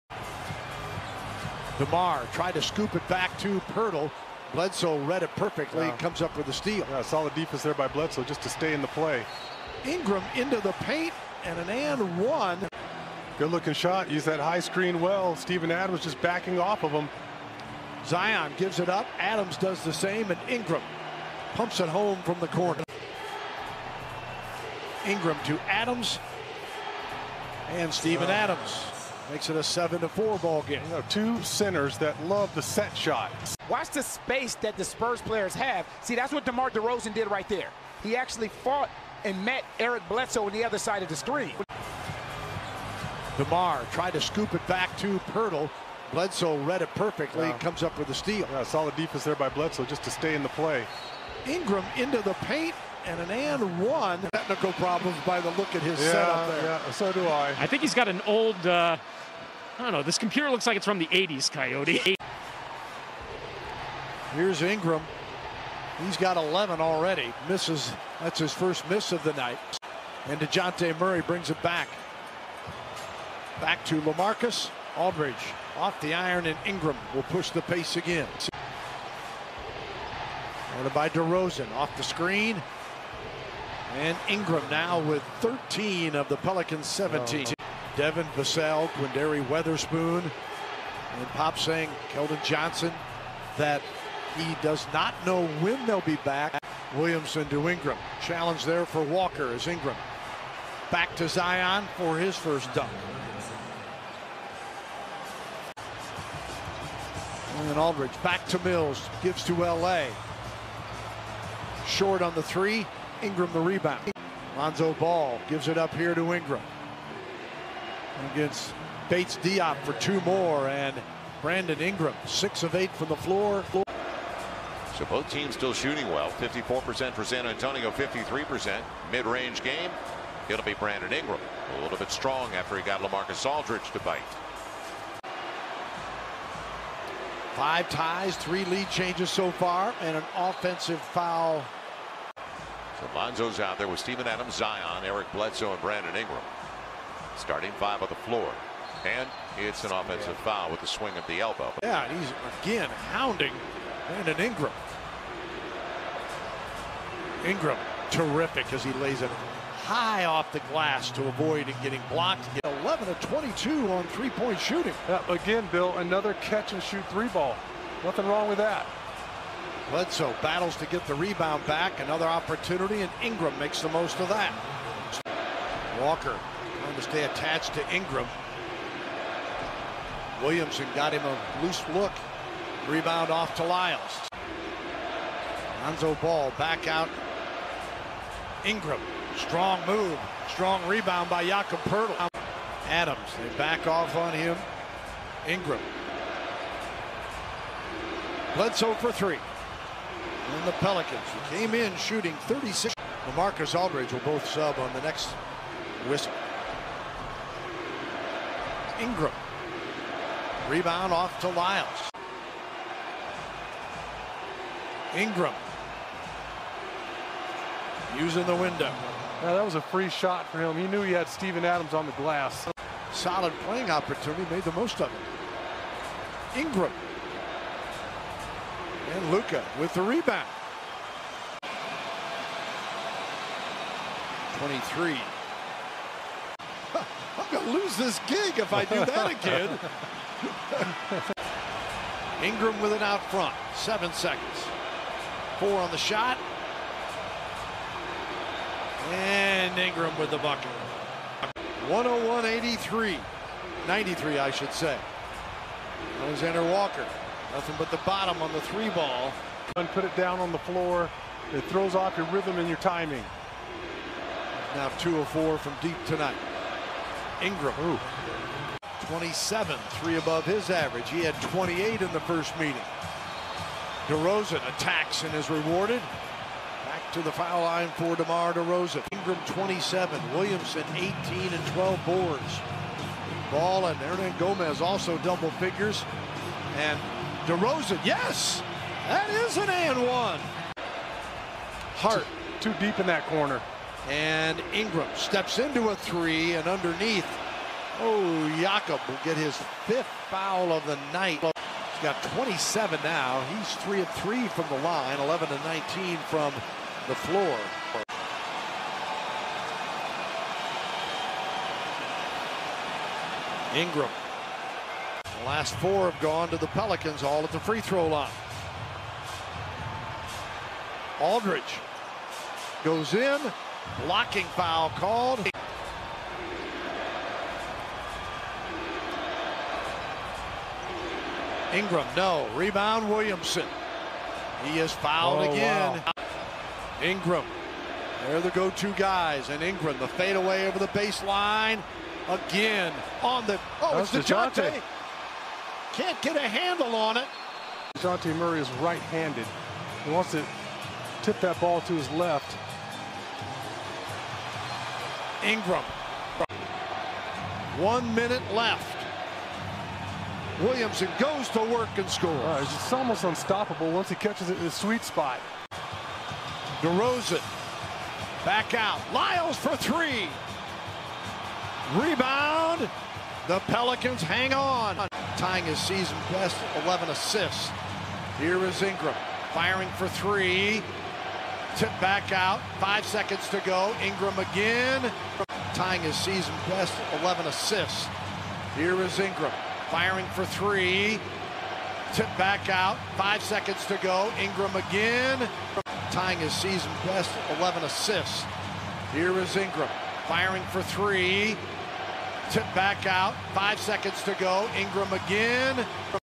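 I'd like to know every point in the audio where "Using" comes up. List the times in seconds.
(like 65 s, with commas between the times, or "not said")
218 s.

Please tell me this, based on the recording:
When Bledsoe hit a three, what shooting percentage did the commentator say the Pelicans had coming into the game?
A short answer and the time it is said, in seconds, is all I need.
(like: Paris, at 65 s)
36, at 202 s.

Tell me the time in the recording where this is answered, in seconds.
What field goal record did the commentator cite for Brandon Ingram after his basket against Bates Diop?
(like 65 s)
122 s.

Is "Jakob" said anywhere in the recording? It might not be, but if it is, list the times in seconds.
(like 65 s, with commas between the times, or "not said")
191 s, 298 s.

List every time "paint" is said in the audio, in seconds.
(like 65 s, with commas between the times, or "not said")
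10 s, 52 s.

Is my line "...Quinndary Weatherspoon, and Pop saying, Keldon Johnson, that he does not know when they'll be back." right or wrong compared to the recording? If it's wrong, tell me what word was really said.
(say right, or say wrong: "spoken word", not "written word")
right.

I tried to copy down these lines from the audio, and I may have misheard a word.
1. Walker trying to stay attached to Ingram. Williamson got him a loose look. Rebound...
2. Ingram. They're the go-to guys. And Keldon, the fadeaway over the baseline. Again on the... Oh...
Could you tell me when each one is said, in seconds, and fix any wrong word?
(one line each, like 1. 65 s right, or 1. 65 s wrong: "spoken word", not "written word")
1. 175 s right
2. 337 s wrong: "Ingram", not "Keldon".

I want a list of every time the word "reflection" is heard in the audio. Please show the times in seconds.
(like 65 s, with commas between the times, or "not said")
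not said.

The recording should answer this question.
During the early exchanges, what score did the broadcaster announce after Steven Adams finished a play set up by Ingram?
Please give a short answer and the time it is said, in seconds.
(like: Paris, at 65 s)
7 to 4, at 29 s.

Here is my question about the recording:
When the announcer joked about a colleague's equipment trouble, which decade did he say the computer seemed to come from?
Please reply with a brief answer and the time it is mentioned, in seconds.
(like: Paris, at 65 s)
The 80s, at 60 s.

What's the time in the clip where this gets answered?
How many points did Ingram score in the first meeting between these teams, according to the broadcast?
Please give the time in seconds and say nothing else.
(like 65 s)
271 s.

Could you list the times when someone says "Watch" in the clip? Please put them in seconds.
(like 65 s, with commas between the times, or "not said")
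33 s.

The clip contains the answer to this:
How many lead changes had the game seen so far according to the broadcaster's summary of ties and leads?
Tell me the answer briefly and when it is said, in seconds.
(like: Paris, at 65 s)
3, at 138 s.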